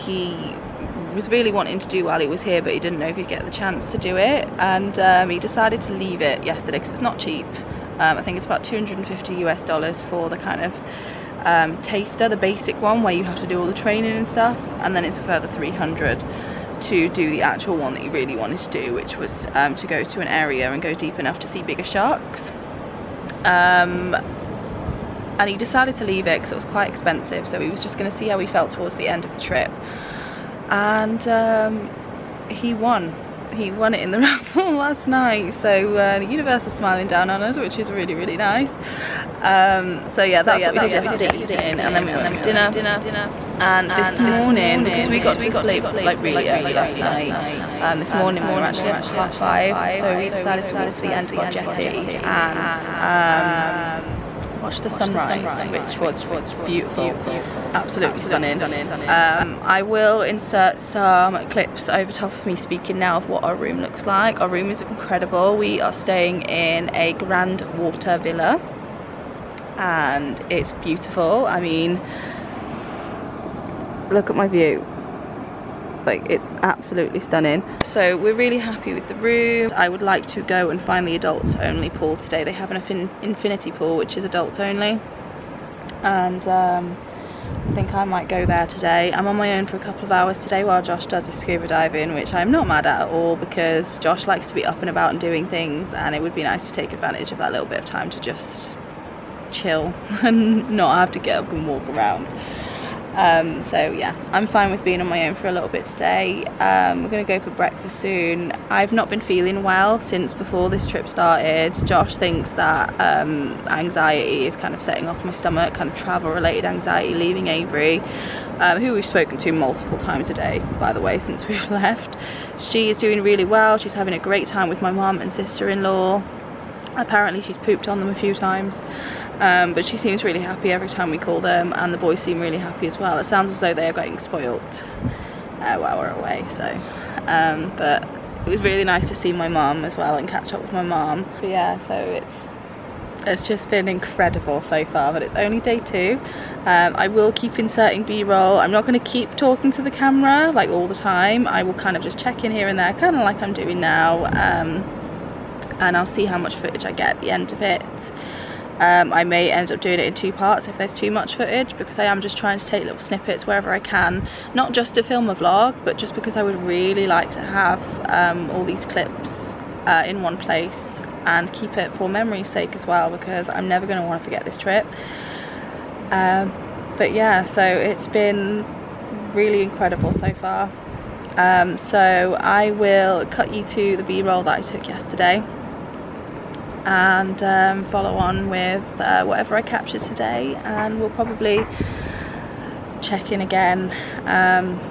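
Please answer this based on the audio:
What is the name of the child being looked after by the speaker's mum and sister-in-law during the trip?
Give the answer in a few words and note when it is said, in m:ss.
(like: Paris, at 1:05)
Avery, at 1:57.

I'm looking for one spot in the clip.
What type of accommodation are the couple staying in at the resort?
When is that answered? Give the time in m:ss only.
1:07.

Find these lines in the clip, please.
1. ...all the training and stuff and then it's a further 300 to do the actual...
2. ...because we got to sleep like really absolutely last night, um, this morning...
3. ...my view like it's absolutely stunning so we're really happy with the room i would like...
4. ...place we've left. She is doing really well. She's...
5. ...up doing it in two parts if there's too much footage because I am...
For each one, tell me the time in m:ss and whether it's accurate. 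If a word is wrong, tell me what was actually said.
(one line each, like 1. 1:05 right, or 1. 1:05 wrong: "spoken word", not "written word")
1. 0:13 right
2. 0:44 wrong: "early", not "absolutely"
3. 1:14 right
4. 2:01 wrong: "since", not "place"
5. 2:39 right.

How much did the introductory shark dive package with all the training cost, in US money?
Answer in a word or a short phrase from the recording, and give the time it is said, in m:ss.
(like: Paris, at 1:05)
$250, at 0:08.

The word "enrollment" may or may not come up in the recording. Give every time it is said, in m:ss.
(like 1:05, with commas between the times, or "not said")
not said.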